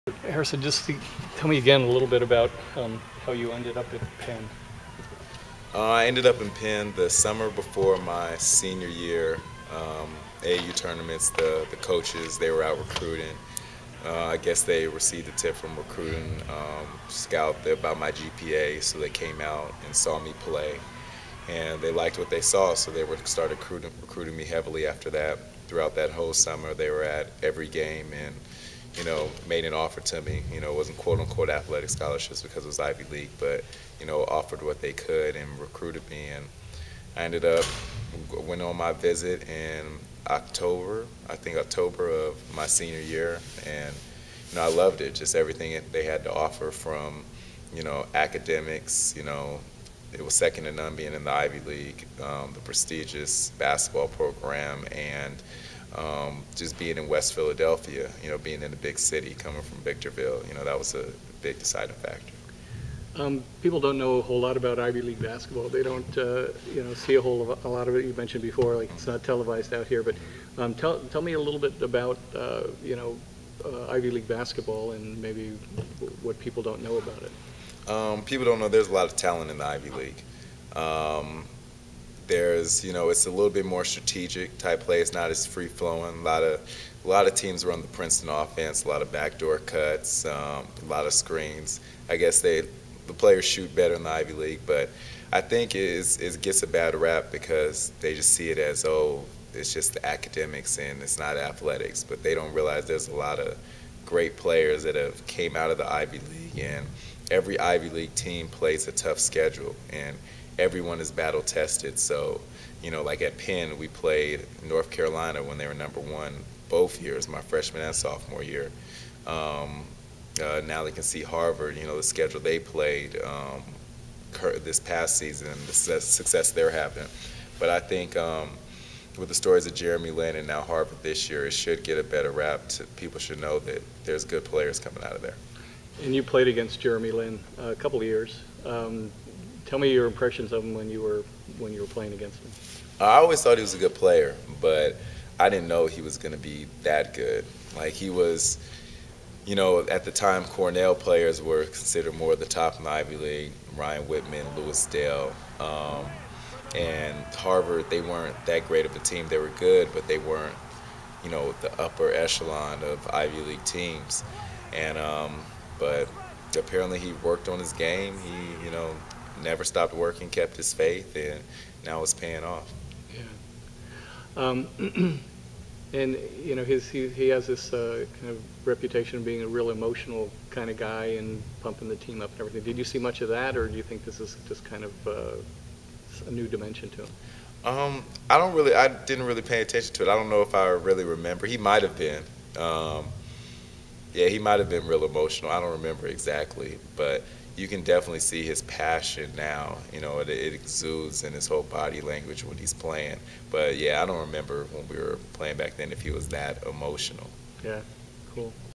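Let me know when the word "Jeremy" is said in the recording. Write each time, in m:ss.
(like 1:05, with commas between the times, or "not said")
2:09, 2:16.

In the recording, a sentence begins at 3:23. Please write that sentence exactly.
But yeah, I don't remember when we were playing back then if he was that emotional.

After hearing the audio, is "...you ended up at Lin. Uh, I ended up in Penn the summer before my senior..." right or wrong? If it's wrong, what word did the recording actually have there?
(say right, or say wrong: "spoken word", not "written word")
wrong: "Penn", not "Lin".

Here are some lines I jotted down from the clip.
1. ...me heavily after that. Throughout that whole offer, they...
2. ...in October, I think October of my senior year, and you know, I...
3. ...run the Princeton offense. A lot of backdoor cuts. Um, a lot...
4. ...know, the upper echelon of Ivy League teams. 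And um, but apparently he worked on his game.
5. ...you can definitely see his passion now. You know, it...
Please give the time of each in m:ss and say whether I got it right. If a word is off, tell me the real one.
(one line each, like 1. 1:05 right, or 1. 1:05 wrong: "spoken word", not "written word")
1. 0:24 wrong: "summer", not "offer"
2. 0:39 right
3. 1:27 right
4. 2:41 right
5. 3:17 right.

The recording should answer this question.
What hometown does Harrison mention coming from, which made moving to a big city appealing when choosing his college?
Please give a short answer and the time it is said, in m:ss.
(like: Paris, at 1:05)
Victorville, at 0:59.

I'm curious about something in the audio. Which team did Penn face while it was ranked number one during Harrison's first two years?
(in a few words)
North Carolina.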